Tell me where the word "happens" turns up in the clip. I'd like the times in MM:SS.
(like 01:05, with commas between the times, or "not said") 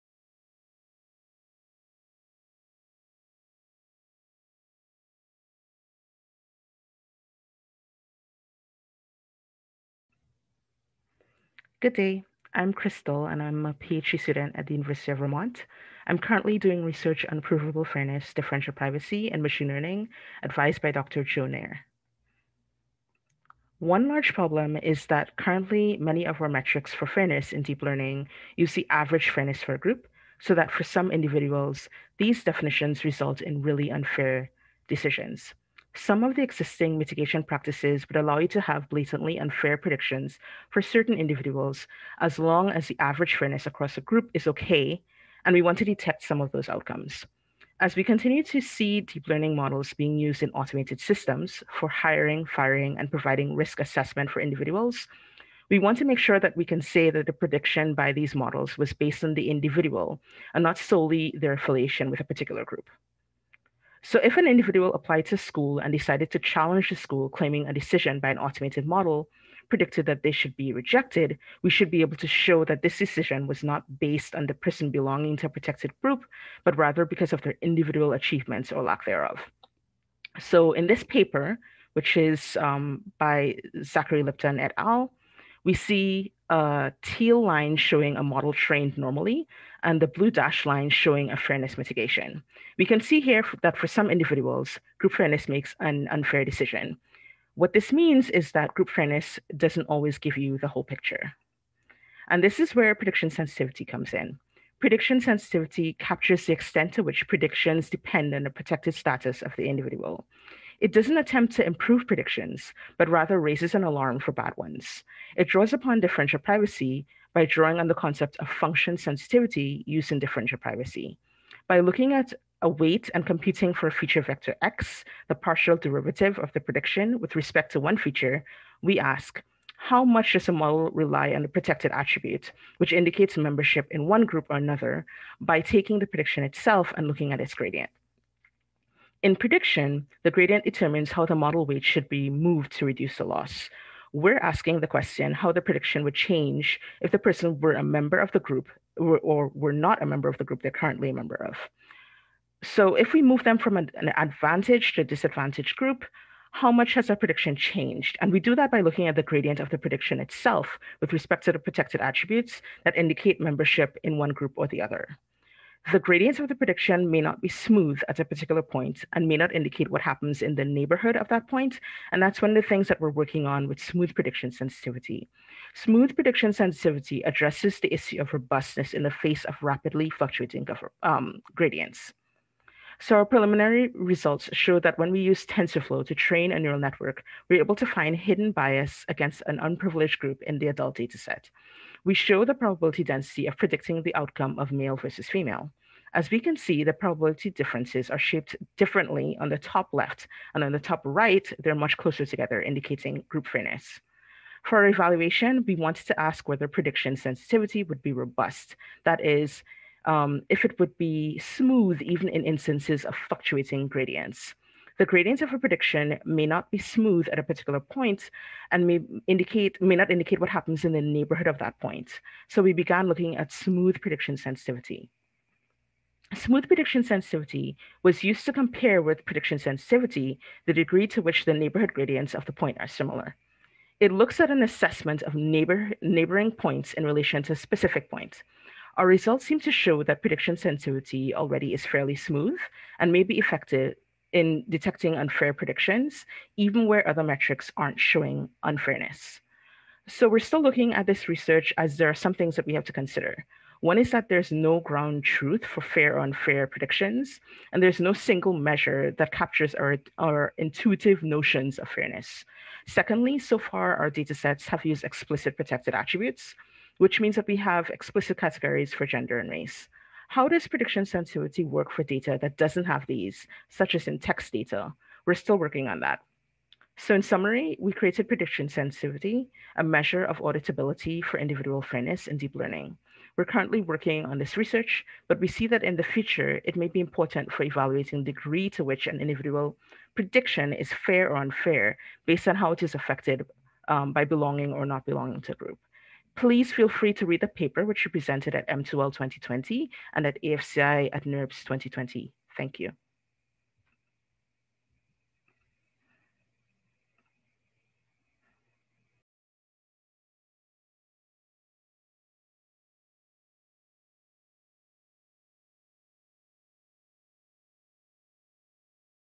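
02:50, 03:40.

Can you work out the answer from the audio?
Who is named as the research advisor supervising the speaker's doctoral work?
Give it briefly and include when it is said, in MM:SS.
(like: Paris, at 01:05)
Joe Near, at 00:21.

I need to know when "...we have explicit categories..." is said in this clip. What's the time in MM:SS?
04:27.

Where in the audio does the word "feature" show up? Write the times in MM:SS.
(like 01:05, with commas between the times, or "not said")
02:03, 02:07.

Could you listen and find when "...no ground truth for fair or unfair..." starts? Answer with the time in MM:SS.
04:14.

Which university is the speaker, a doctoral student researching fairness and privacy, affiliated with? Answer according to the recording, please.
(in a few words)
University of Vermont.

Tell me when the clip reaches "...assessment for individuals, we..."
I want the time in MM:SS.
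00:53.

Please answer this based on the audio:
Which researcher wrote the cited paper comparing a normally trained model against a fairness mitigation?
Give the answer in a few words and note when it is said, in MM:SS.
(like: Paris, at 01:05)
Zachary Lipton, at 01:23.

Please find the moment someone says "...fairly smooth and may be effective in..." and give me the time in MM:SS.
04:01.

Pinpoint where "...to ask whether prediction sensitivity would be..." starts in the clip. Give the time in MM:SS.
03:26.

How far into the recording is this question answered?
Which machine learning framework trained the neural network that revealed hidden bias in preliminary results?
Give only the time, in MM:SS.
03:05.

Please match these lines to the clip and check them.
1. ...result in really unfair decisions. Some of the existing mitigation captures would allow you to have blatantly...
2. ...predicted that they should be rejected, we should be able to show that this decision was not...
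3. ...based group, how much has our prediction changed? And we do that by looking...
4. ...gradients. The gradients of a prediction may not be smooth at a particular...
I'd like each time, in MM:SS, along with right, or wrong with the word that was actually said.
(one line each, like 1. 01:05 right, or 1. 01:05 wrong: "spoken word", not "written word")
1. 00:33 wrong: "practices", not "captures"
2. 01:09 right
3. 02:35 wrong: "disadvantaged", not "based"
4. 03:33 right.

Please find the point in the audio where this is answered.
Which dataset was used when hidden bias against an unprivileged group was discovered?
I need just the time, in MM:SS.
03:10.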